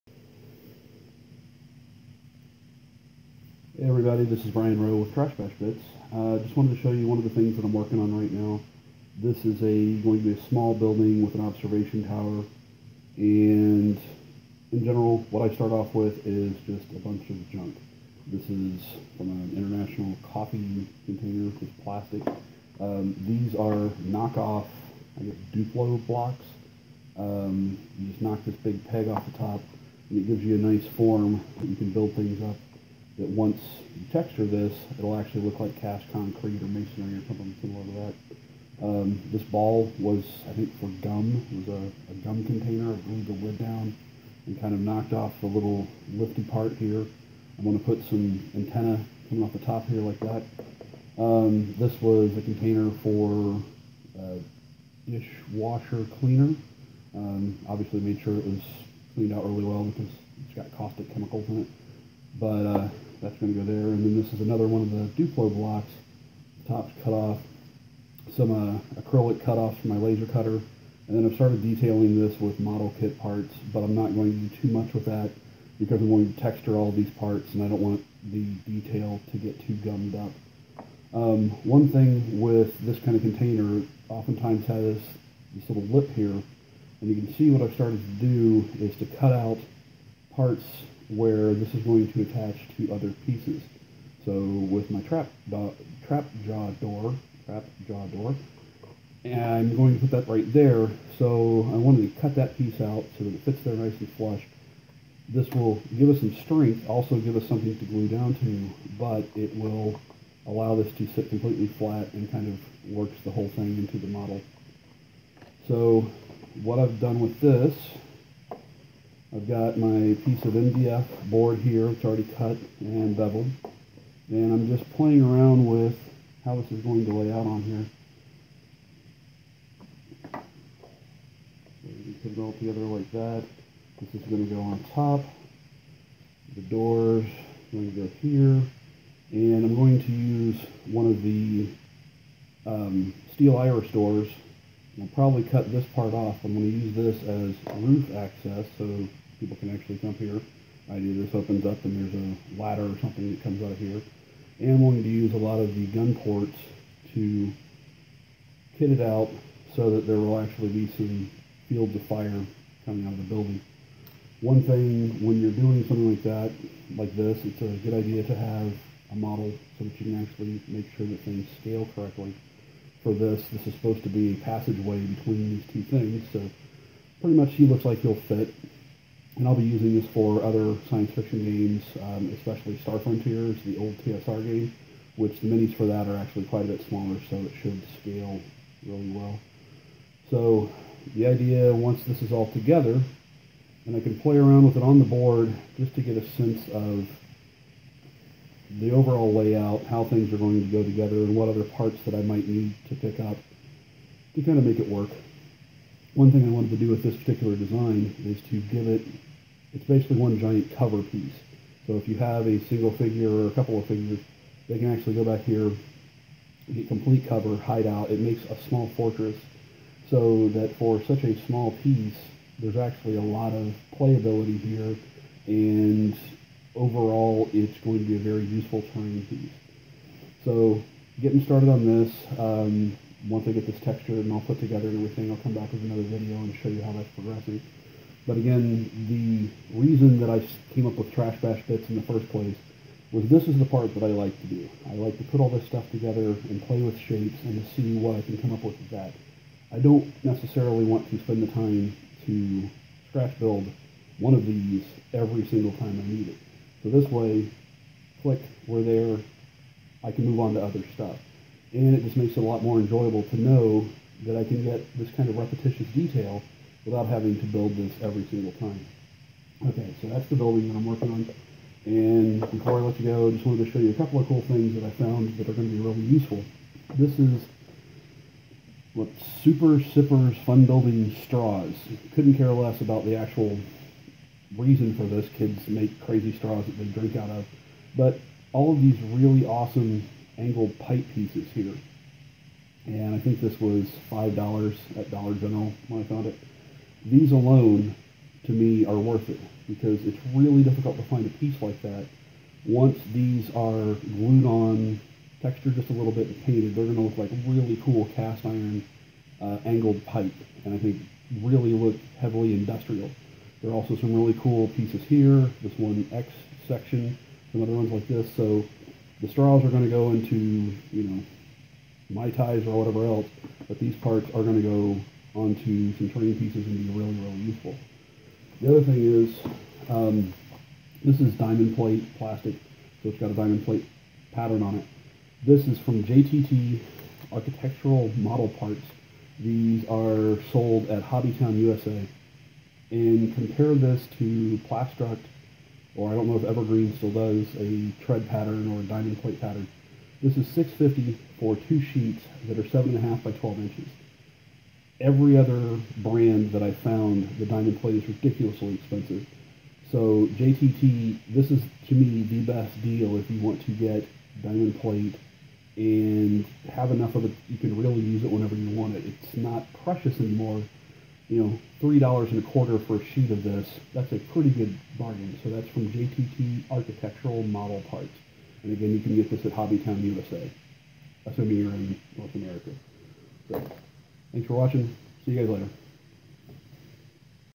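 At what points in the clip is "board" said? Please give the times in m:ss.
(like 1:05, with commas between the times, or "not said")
2:01, 3:15.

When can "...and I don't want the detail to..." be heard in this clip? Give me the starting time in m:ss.
1:17.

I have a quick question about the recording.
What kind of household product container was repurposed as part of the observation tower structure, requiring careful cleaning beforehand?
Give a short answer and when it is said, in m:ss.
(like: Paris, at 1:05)
Dishwasher cleaner, at 0:55.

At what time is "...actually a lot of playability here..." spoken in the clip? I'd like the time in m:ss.
3:42.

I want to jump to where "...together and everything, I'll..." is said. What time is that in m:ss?
3:54.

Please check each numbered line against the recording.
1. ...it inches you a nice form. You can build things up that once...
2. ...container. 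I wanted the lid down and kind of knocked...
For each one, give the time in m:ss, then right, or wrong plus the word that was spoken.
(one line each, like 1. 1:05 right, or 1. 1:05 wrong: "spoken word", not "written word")
1. 0:30 wrong: "gives", not "inches"
2. 0:42 wrong: "glued", not "wanted".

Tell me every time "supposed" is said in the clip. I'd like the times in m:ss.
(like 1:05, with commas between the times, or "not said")
2:53.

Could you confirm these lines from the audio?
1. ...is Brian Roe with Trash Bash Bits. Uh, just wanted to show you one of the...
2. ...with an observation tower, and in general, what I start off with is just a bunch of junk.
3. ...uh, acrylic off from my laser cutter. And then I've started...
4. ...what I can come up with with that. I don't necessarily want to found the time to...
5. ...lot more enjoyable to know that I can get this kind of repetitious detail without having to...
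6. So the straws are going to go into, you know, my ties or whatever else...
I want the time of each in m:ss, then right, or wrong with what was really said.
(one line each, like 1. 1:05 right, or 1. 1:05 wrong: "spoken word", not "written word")
1. 0:04 right
2. 0:11 right
3. 1:08 right
4. 4:07 wrong: "spend", not "found"
5. 4:22 right
6. 5:18 right.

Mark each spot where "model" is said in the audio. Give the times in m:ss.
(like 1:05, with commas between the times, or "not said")
1:12, 1:54, 2:49, 5:38, 6:17.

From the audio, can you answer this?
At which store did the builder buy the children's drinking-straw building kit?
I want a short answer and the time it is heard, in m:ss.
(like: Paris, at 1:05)
Dollar General, at 4:55.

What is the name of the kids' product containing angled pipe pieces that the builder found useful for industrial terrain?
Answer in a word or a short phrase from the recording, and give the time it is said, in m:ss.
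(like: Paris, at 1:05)
Super Sippers Fun Building Straws, at 4:39.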